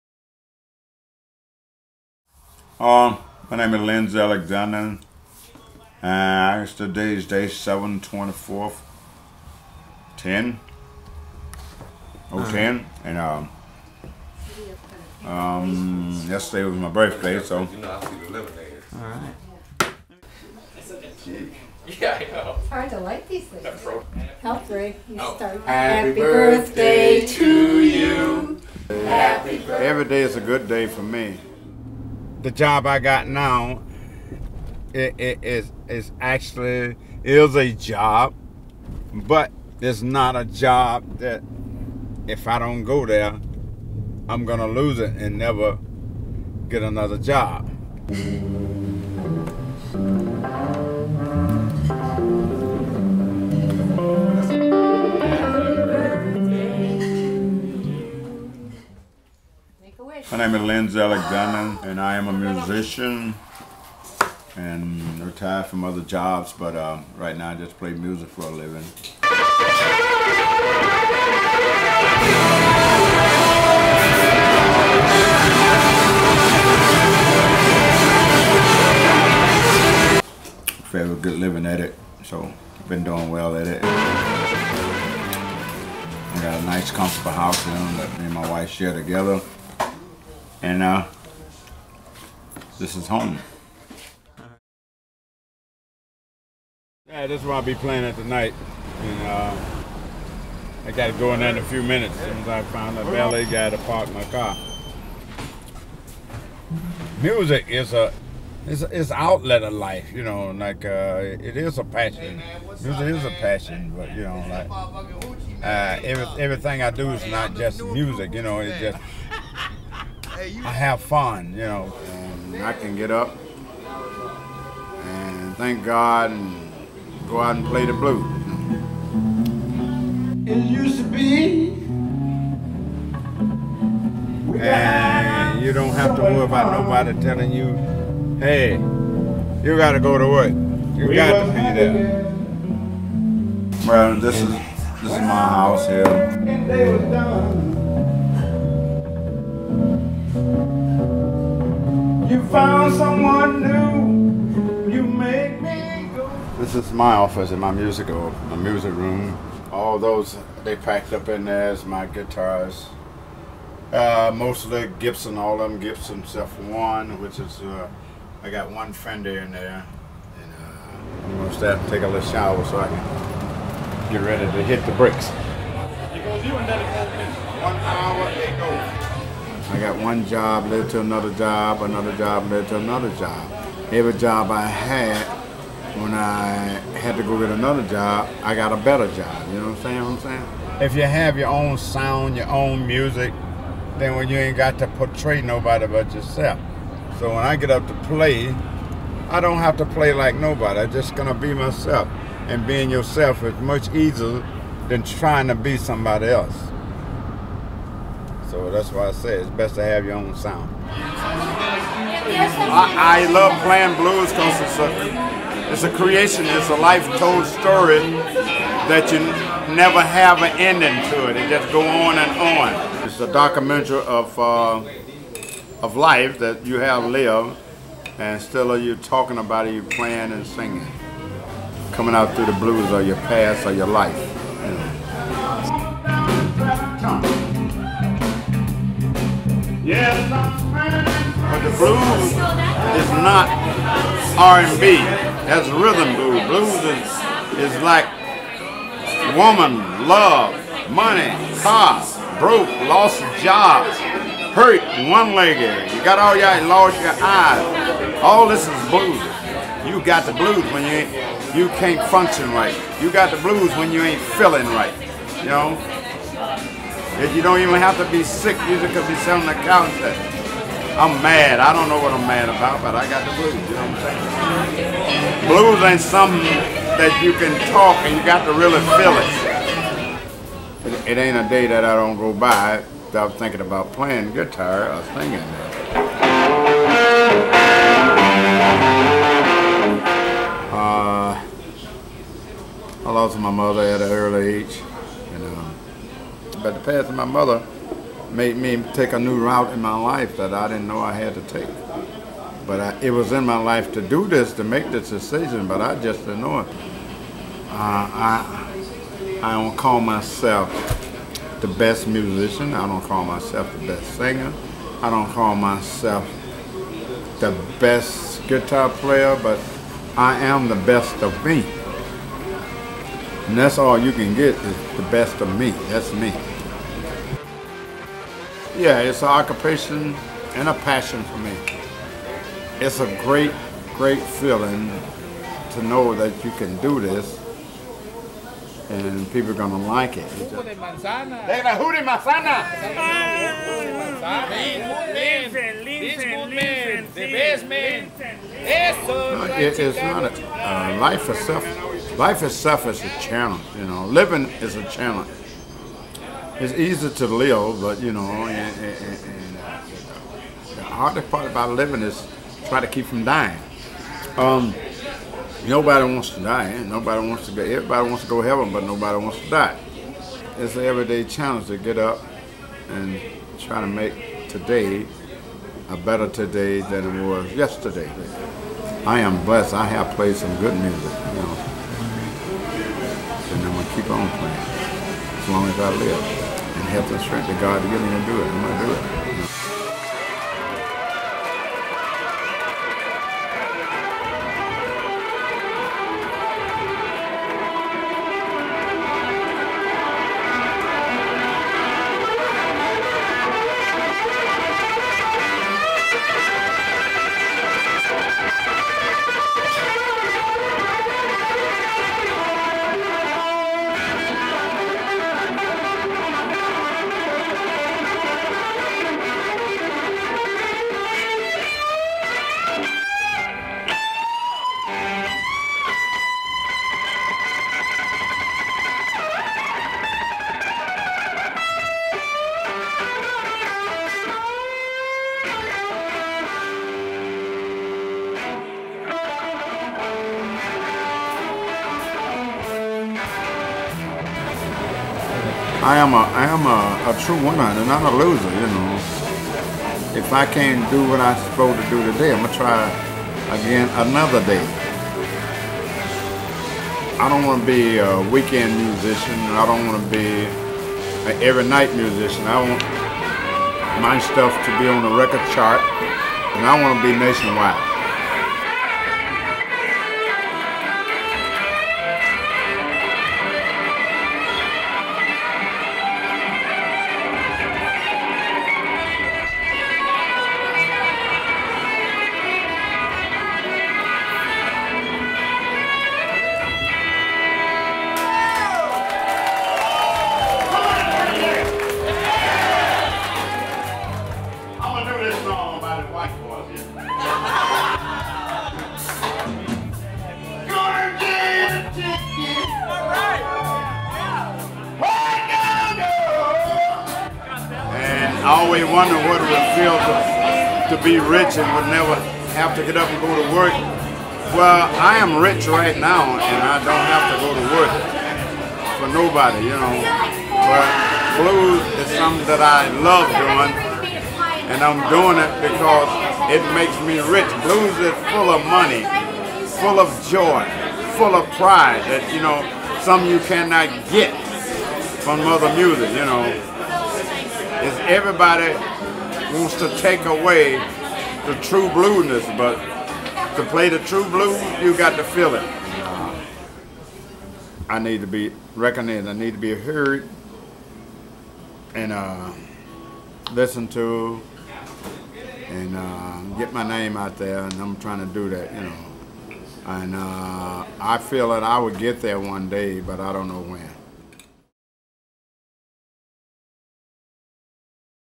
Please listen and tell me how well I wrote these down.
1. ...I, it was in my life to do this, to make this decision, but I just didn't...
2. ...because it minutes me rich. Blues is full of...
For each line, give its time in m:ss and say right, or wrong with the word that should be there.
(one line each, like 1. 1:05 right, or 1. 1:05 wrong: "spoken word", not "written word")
1. 5:02 right
2. 8:45 wrong: "makes", not "minutes".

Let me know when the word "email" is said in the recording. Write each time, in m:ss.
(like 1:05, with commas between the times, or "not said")
not said.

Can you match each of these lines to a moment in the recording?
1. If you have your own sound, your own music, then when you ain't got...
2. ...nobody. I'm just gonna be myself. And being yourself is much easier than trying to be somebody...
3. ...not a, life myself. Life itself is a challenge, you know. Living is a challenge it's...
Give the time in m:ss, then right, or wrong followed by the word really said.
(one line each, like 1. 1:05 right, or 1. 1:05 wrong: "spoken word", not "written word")
1. 3:10 right
2. 3:20 right
3. 5:50 wrong: "itself", not "myself".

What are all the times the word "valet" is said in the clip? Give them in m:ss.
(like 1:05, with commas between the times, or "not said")
1:43.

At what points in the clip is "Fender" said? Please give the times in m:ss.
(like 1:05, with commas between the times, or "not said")
2:48.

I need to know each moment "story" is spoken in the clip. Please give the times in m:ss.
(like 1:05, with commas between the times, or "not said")
3:37.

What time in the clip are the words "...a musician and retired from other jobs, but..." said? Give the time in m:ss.
1:02.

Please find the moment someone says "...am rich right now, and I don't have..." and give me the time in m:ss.
8:35.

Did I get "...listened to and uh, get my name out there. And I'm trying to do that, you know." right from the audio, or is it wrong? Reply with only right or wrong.
right.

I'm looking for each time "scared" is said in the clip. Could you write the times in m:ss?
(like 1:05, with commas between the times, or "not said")
not said.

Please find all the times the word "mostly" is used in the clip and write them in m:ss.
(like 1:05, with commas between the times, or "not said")
2:44.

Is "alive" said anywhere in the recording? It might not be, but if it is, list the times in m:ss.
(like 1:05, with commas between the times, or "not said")
not said.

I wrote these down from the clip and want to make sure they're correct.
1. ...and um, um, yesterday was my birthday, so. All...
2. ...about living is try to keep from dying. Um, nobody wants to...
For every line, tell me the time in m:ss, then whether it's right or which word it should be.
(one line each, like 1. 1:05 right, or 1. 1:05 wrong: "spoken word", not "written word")
1. 0:13 right
2. 6:01 right.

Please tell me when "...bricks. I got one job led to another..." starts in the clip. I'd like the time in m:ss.
2:54.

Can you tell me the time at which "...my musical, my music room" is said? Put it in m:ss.
2:37.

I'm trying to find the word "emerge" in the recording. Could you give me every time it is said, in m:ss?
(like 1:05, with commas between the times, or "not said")
not said.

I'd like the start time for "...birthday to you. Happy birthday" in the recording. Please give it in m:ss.
0:26.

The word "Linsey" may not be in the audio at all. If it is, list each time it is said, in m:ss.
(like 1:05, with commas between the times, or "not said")
0:03, 1:00.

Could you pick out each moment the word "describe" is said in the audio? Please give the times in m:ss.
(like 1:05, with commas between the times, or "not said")
not said.